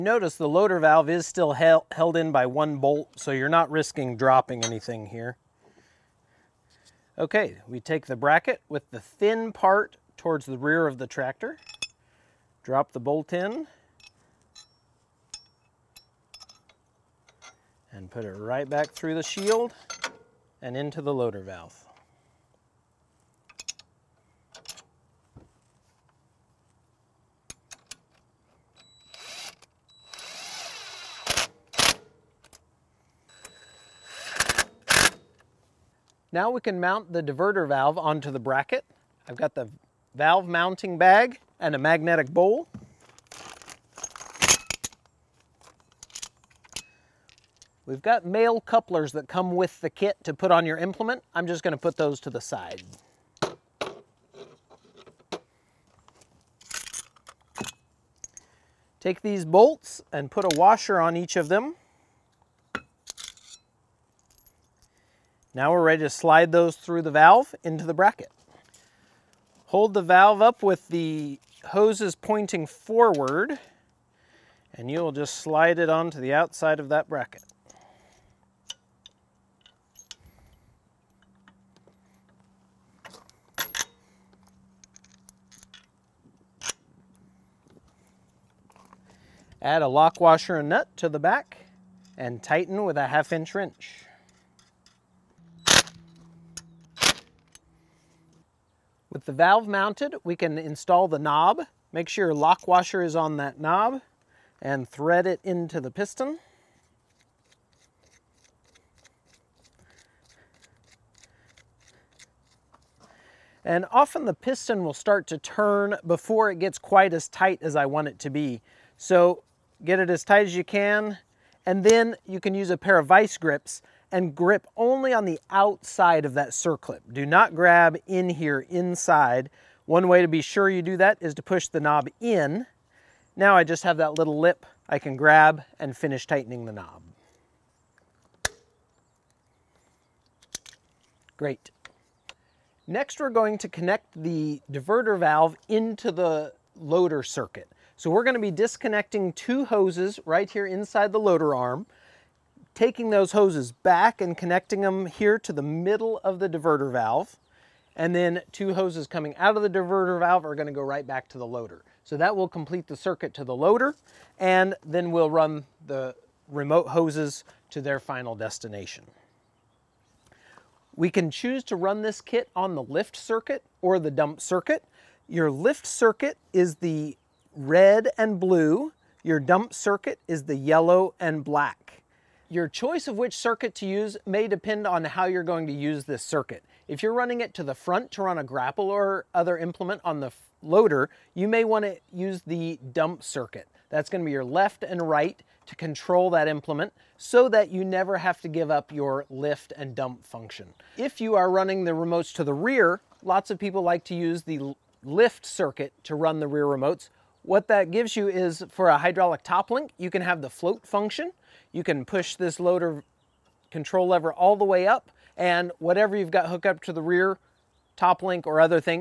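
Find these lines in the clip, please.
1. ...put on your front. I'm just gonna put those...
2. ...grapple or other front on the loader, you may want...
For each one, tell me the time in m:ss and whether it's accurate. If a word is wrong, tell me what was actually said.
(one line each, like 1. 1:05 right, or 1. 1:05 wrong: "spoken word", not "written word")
1. 0:50 wrong: "implement", not "front"
2. 3:08 wrong: "implement", not "front".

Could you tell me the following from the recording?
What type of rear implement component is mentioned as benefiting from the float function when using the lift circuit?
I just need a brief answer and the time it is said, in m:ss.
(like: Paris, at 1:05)
hydraulic top link, at 3:28.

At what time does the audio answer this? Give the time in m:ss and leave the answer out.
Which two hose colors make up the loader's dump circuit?
3:00.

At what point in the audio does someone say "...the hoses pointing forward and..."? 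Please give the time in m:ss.
1:10.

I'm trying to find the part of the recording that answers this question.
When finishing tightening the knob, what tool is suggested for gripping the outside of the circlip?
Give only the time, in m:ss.
2:03.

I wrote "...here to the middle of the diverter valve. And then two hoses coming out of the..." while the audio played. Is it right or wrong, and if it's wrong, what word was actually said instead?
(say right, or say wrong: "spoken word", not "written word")
right.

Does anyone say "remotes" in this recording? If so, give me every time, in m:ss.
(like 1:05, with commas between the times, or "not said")
2:46, 3:21, 3:26.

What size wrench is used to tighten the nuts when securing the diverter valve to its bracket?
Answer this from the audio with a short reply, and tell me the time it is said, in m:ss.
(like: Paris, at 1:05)
1/2 inch, at 1:33.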